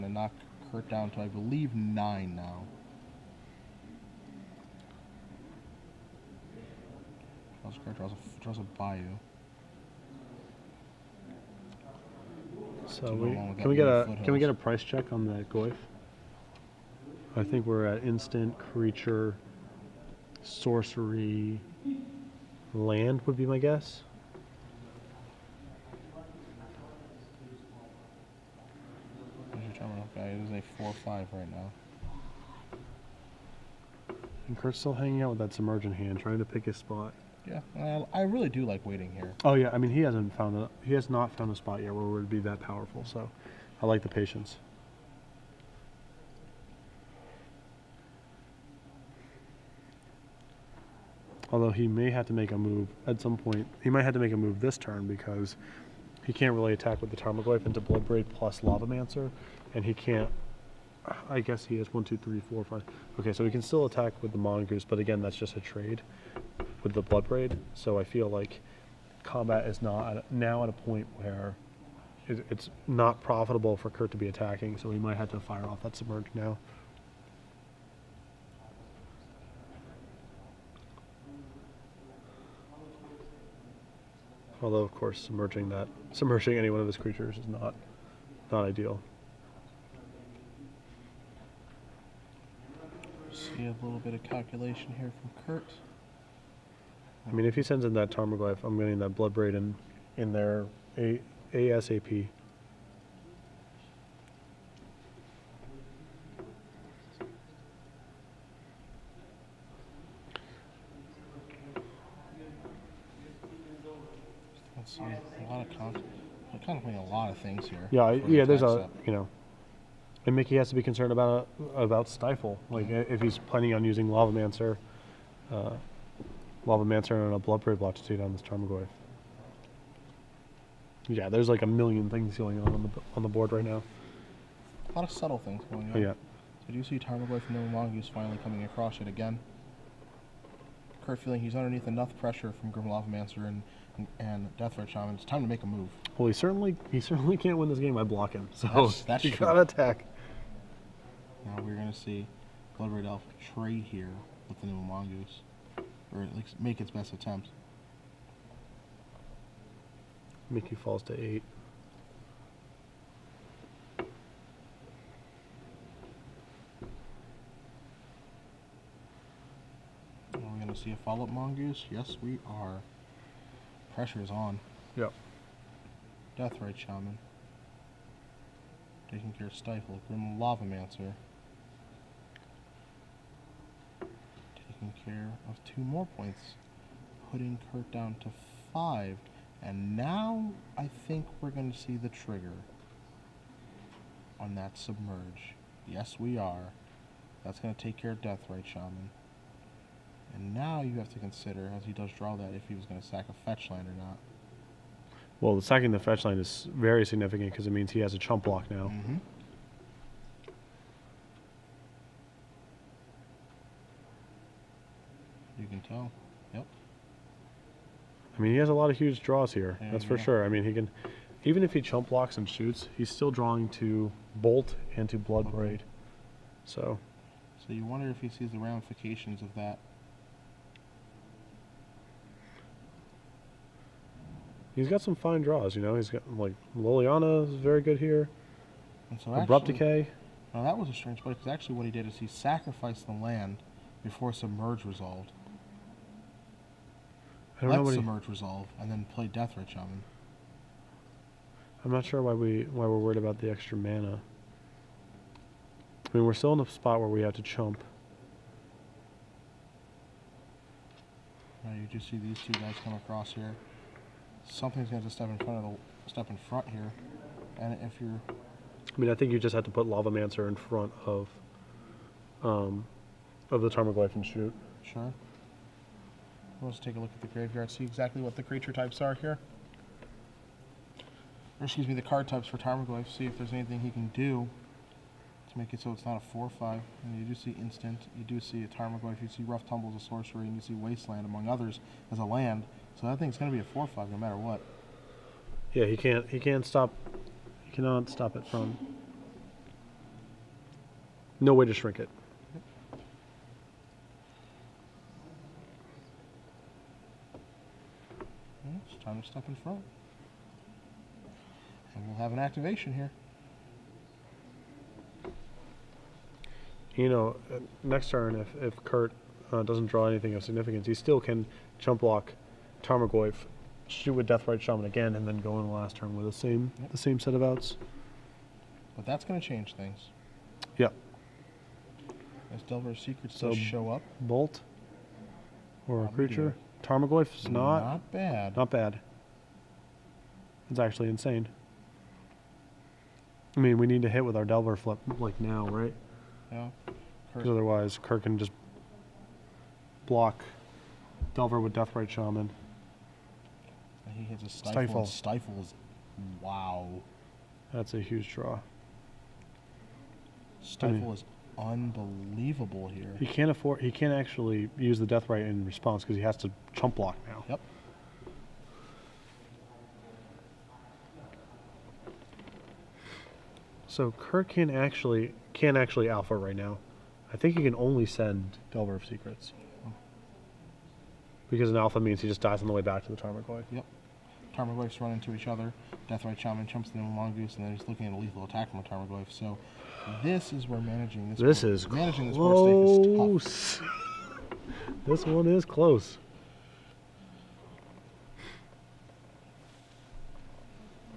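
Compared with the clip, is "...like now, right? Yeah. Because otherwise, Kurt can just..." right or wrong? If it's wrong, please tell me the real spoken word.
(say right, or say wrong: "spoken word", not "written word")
right.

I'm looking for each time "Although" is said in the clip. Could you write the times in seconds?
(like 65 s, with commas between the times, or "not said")
51 s, 84 s.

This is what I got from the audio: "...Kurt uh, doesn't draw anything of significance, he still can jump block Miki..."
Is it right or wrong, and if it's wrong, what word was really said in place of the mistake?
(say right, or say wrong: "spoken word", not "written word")
wrong: "Tarmogoyf", not "Miki".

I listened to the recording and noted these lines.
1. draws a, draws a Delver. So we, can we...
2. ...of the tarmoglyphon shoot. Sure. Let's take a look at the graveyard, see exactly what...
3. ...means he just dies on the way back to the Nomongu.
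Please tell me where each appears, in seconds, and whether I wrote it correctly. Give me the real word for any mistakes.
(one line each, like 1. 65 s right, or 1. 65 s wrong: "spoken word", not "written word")
1. 7 s wrong: "Bayou", not "Delver"
2. 273 s right
3. 381 s wrong: "Tarmogoyf", not "Nomongu".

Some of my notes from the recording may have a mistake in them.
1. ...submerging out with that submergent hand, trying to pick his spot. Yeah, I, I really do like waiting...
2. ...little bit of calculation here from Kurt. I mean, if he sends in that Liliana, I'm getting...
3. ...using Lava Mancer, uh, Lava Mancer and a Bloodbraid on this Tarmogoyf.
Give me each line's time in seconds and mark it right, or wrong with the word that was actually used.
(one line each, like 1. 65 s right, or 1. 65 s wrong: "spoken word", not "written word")
1. 34 s wrong: "hanging", not "submerging"
2. 93 s wrong: "Tarmogoyf", not "Liliana"
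3. 123 s right.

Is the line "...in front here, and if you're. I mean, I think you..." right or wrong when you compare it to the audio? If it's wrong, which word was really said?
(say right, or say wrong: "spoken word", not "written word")
right.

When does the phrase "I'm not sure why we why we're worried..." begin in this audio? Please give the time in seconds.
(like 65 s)
251 s.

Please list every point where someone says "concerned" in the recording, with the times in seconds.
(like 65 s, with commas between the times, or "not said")
120 s.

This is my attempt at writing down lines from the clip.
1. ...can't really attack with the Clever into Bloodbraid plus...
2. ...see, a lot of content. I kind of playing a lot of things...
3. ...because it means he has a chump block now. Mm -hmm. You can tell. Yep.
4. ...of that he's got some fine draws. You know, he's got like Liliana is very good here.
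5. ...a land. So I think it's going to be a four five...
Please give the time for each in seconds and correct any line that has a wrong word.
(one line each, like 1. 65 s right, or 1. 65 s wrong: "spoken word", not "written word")
1. 56 s wrong: "Tarmogoyf", not "Clever"
2. 114 s right
3. 207 s right
4. 229 s right
5. 292 s right.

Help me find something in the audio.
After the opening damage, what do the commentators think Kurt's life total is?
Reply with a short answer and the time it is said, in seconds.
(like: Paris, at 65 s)
9, at 1 s.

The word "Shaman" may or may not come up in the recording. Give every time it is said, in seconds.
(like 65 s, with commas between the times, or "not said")
144 s, 176 s, 198 s, 324 s, 352 s, 386 s.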